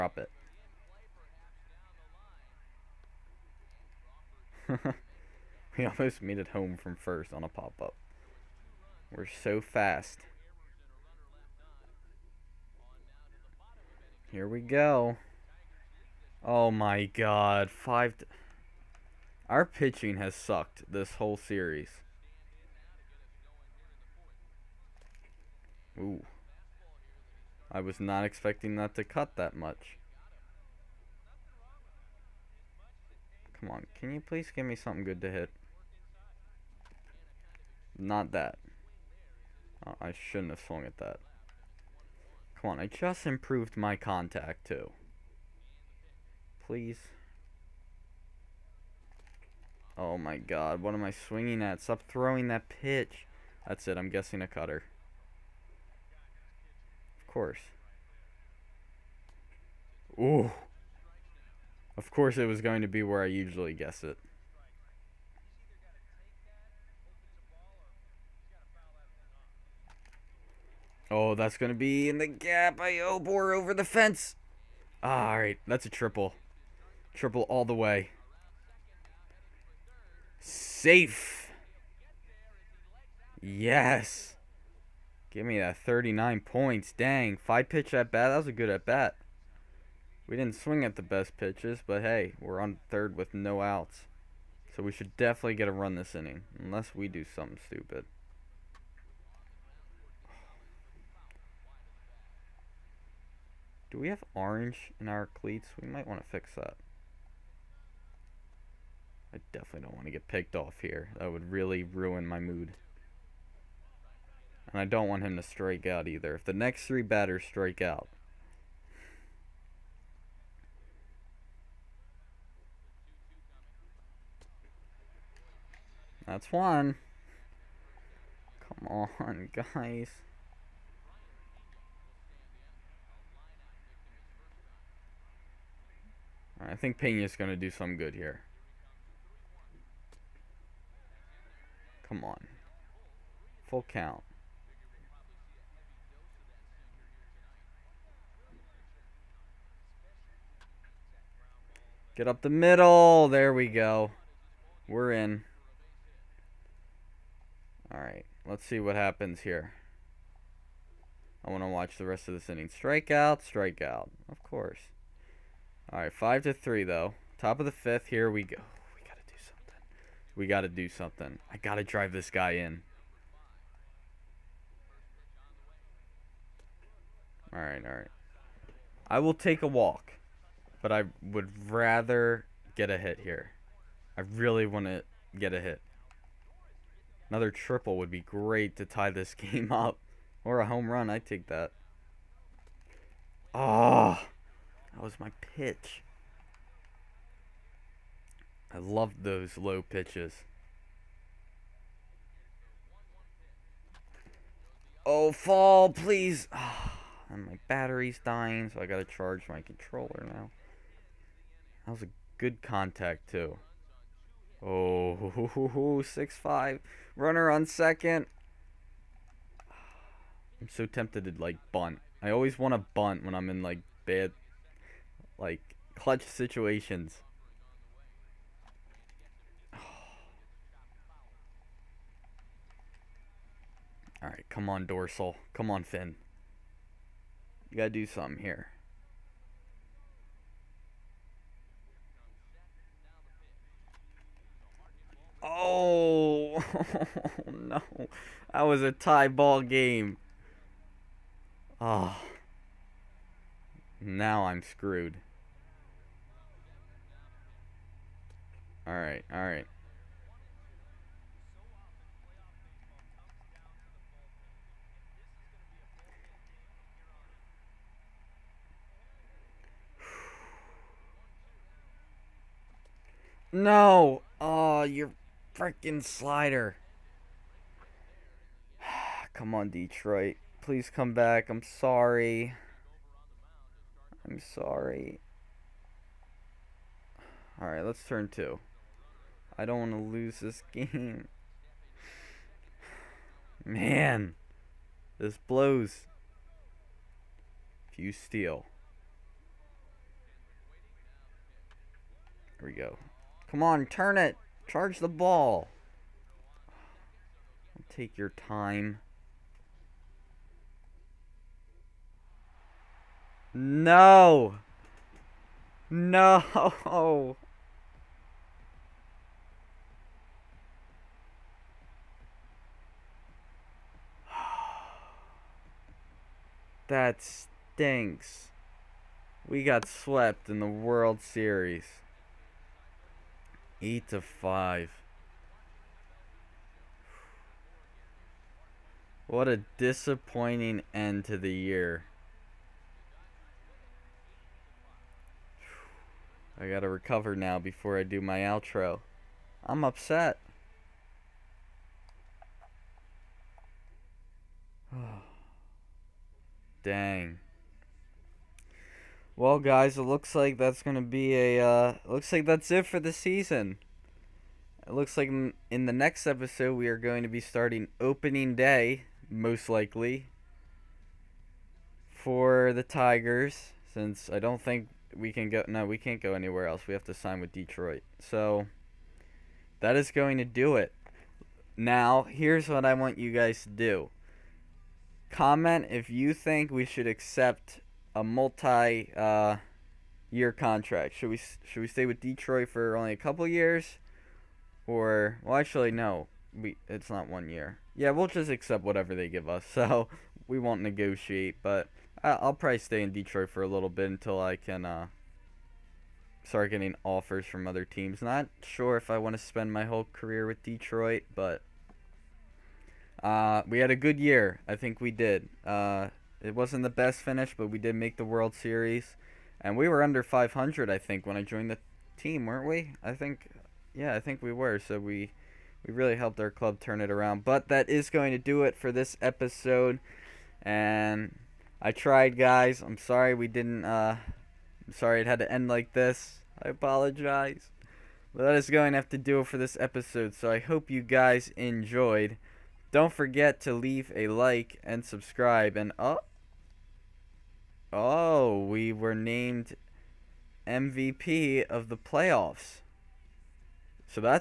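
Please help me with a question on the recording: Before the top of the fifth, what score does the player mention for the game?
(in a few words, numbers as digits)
5 to 3.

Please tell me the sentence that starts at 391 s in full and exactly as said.
Should we should we stay with Detroit for only a couple years, or well, actually no, we it's not one year.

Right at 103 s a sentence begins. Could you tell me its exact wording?
Do we have orange in our cleats?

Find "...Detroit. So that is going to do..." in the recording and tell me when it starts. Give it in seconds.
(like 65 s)
377 s.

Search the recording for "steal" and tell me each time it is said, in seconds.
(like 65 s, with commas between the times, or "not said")
298 s.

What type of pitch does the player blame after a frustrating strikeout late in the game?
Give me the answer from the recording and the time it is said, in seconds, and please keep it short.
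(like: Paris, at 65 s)
Slider, at 276 s.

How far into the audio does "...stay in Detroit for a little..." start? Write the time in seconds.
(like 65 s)
402 s.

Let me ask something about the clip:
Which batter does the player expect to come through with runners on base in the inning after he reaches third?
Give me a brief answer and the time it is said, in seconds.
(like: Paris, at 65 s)
Pena, at 136 s.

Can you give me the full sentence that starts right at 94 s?
So we should definitely get a run this inning, unless we do something stupid.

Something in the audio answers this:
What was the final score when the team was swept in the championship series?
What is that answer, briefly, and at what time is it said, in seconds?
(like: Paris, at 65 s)
8 to 5, at 333 s.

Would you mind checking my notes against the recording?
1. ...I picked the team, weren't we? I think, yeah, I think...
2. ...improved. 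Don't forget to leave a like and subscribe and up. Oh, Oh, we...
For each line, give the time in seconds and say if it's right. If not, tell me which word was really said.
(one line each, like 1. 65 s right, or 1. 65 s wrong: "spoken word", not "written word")
1. 421 s wrong: "joined", not "picked"
2. 441 s wrong: "enjoyed", not "improved".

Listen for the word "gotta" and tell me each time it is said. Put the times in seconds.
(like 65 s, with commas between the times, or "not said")
208 s, 237 s, 346 s.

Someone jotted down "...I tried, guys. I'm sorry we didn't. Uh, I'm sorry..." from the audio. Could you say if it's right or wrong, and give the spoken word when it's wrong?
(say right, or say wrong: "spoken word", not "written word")
right.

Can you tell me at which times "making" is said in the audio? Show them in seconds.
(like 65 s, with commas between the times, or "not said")
not said.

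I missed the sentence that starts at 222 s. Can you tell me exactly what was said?
I always want to bunt when I'm in, like, bad, like, clutch situations.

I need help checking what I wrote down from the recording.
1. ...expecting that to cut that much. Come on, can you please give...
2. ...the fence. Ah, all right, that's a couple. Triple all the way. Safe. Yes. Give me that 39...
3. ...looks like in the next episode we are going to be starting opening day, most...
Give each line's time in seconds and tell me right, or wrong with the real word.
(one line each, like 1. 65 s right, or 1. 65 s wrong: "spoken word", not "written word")
1. 28 s right
2. 73 s wrong: "triple", not "couple"
3. 364 s right.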